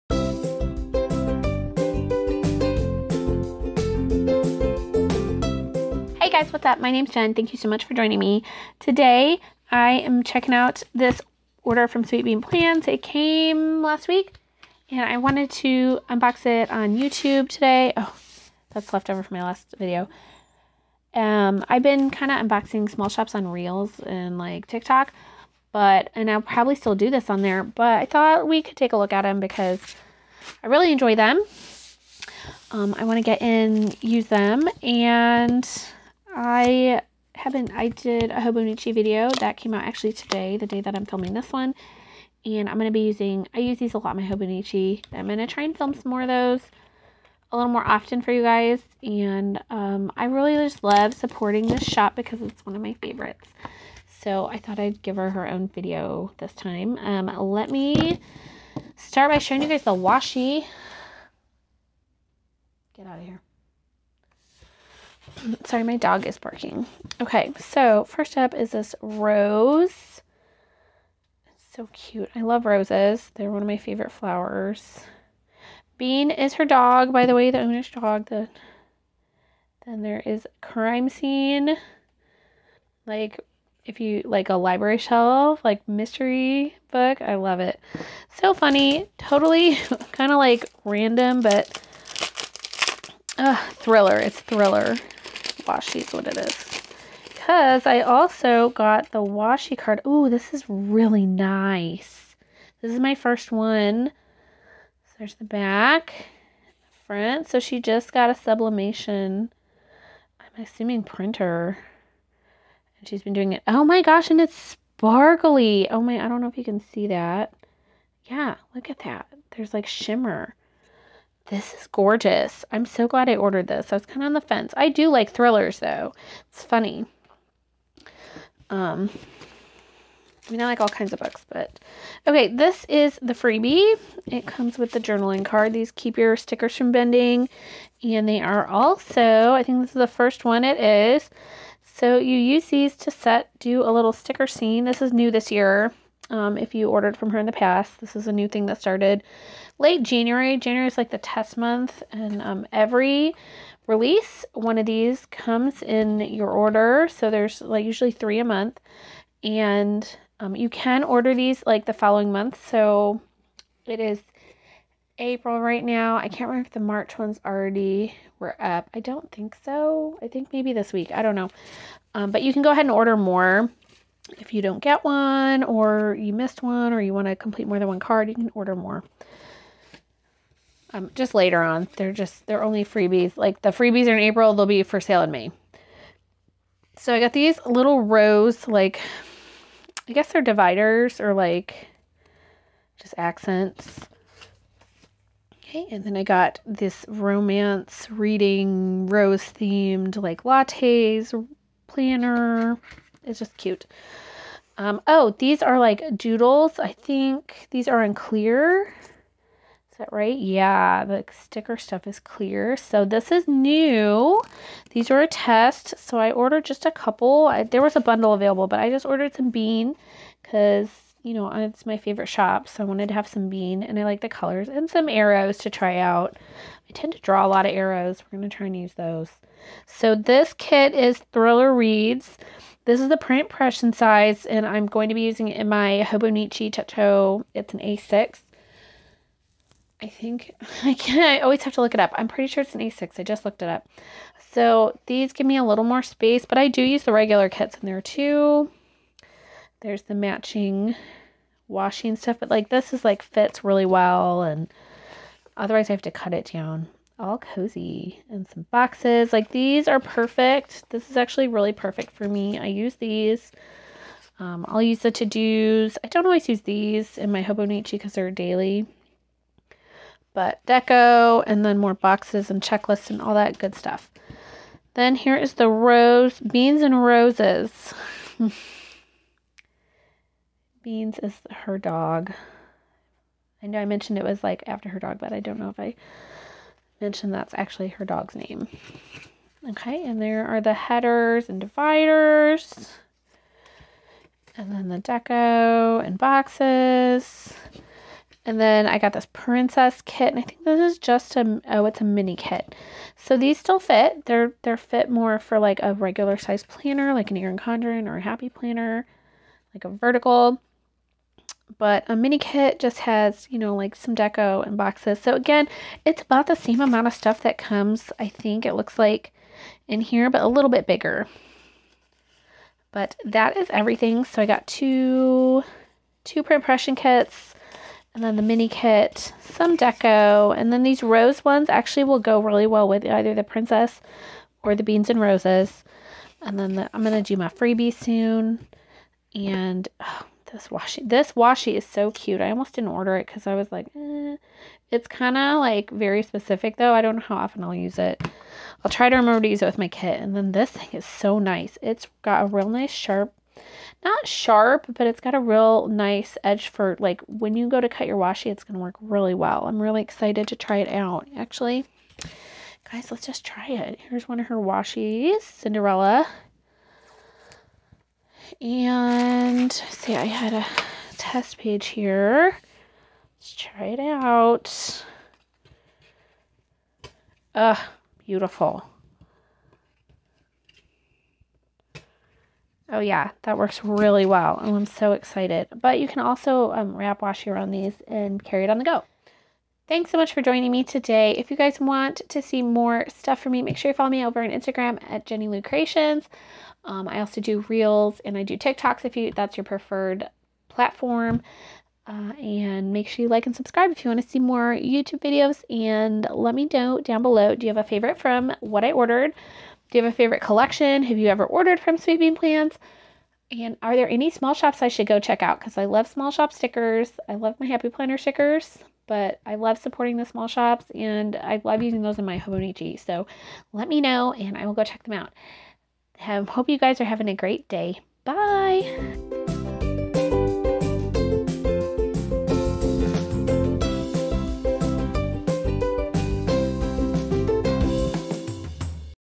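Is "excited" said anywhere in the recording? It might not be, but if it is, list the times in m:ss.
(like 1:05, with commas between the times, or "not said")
6:00, 6:25.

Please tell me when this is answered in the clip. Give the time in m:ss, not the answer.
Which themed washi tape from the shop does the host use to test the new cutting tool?
6:05.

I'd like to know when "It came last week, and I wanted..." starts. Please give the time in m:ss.
0:12.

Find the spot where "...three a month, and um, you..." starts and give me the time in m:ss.
2:38.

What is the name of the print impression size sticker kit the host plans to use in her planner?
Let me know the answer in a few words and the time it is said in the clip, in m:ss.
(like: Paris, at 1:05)
Thriller Reads, at 3:51.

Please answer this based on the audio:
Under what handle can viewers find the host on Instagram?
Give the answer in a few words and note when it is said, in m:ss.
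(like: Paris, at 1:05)
Jenny Lou Creations, at 6:35.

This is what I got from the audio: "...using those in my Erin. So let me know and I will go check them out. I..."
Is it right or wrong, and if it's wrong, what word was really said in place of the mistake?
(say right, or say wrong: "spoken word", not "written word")
wrong: "Hobonichi", not "Erin".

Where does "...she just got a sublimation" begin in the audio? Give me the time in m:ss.
1:47.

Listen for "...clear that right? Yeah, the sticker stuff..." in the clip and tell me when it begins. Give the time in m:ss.
3:28.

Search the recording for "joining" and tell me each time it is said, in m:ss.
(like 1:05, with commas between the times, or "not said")
0:07, 6:30.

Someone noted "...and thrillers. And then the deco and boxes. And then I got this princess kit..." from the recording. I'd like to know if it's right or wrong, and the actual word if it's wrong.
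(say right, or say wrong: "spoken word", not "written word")
wrong: "dividers", not "thrillers".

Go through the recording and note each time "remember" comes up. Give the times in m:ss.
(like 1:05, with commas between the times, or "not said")
2:46, 5:49.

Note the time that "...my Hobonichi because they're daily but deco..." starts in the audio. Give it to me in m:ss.
4:27.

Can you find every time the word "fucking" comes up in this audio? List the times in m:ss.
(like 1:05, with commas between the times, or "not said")
not said.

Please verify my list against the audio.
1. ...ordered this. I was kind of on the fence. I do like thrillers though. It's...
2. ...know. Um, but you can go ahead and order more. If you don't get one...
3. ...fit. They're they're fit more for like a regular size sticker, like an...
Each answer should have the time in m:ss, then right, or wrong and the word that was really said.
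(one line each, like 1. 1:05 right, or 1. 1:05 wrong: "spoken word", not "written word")
1. 2:03 right
2. 2:51 right
3. 5:03 wrong: "planner", not "sticker".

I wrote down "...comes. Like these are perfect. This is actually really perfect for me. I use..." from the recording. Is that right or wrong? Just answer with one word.
wrong.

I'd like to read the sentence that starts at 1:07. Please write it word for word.
Okay, so first up is this rose.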